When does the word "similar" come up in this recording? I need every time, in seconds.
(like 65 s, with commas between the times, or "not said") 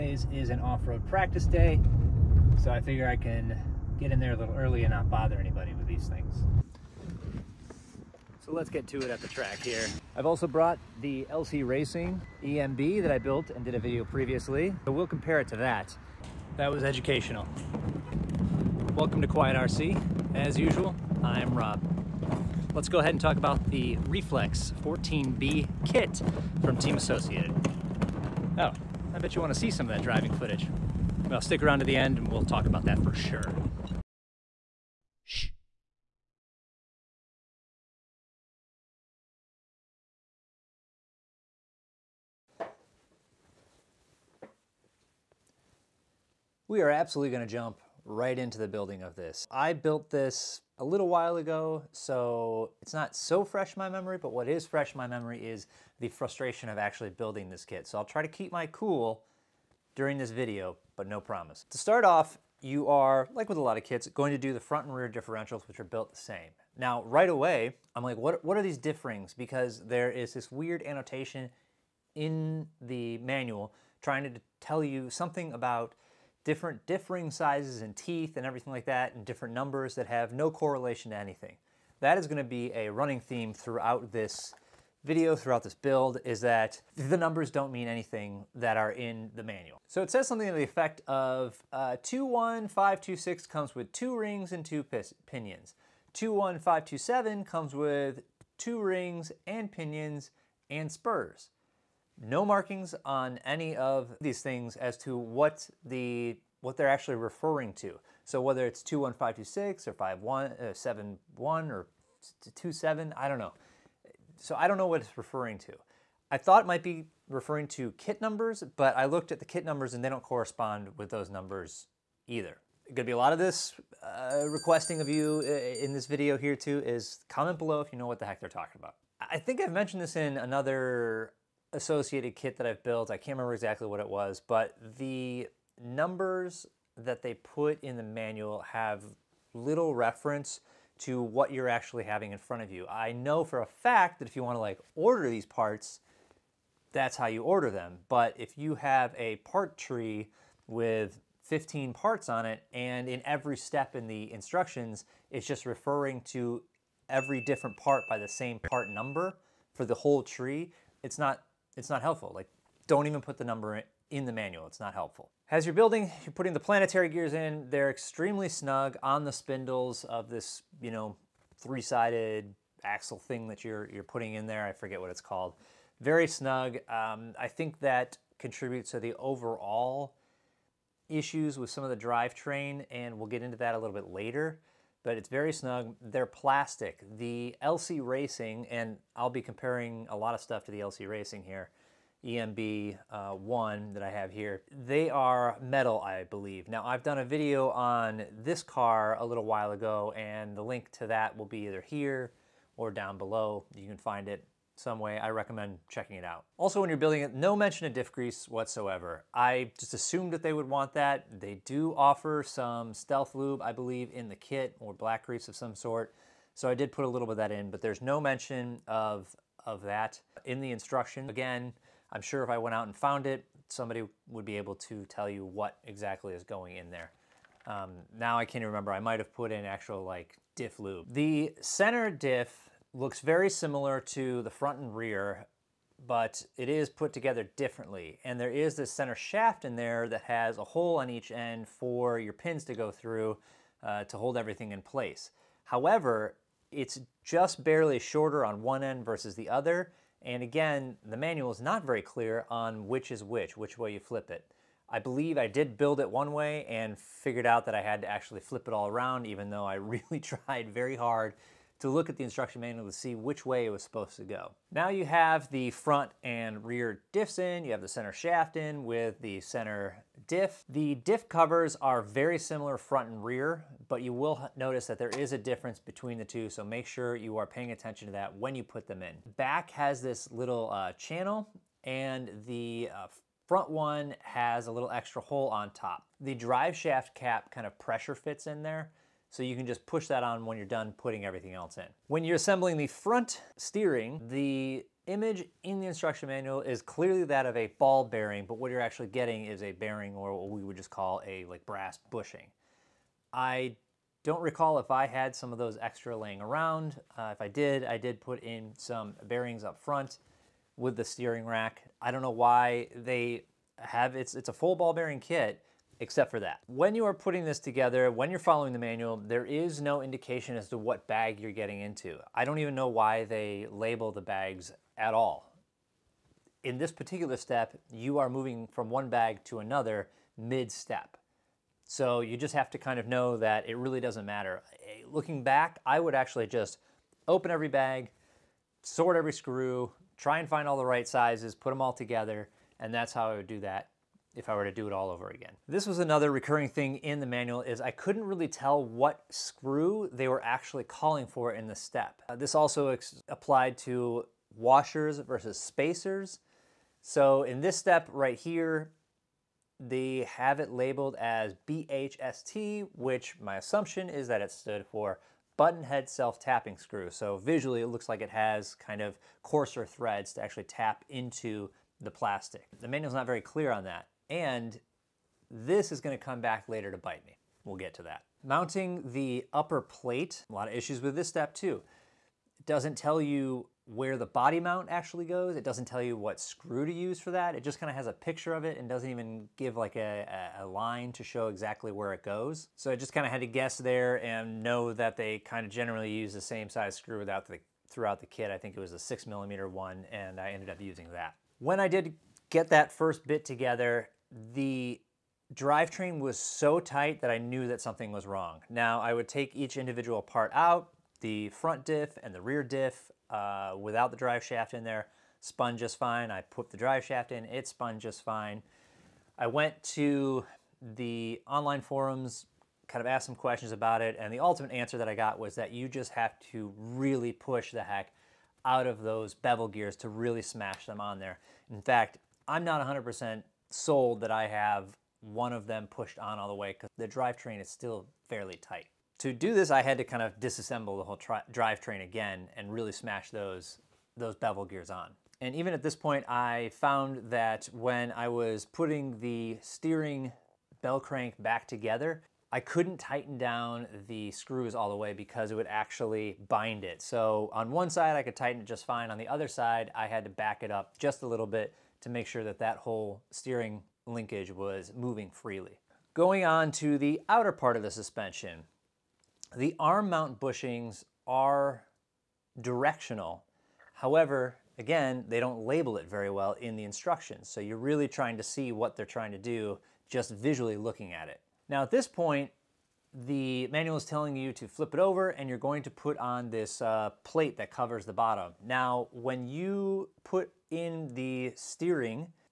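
233 s, 272 s.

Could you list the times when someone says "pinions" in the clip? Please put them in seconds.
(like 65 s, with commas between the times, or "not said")
95 s, 99 s.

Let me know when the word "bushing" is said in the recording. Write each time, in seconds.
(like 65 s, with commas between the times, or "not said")
302 s, 470 s.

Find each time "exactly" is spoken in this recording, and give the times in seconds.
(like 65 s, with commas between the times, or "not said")
133 s, 225 s, 391 s.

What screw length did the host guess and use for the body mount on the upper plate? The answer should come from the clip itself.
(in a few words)
6 millimeter.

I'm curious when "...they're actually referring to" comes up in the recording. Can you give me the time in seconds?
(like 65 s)
106 s.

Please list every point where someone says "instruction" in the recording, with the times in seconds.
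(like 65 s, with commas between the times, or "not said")
154 s, 220 s, 262 s, 295 s, 476 s.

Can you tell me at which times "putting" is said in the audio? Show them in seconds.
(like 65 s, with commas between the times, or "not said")
166 s, 174 s, 290 s, 317 s, 448 s.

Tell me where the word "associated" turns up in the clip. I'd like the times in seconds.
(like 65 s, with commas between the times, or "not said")
26 s, 131 s.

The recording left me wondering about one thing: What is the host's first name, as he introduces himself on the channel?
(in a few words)
Rob.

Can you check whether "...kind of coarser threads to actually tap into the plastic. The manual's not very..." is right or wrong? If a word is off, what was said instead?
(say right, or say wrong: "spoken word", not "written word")
right.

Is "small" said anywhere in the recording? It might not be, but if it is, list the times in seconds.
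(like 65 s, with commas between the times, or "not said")
not said.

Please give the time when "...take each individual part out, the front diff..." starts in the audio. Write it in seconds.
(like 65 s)
409 s.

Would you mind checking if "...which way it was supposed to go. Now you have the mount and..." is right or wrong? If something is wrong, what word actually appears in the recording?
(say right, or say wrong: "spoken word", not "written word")
wrong: "front", not "mount".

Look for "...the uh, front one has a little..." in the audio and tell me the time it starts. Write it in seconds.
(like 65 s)
282 s.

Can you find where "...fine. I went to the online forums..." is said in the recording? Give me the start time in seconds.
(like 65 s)
418 s.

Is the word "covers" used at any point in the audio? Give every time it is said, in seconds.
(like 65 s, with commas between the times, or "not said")
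271 s, 487 s.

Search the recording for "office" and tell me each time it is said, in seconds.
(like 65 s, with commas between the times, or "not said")
not said.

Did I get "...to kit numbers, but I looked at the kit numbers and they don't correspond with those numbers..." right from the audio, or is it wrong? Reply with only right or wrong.
right.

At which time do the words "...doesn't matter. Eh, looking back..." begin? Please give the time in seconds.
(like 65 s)
333 s.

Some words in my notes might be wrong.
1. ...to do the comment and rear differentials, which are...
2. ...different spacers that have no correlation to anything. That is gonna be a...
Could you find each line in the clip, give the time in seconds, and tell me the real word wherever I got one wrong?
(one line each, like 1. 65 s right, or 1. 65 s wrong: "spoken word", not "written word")
1. 64 s wrong: "front", not "comment"
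2. 79 s wrong: "numbers", not "spacers".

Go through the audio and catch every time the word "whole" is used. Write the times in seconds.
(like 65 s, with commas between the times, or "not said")
159 s, 441 s, 462 s.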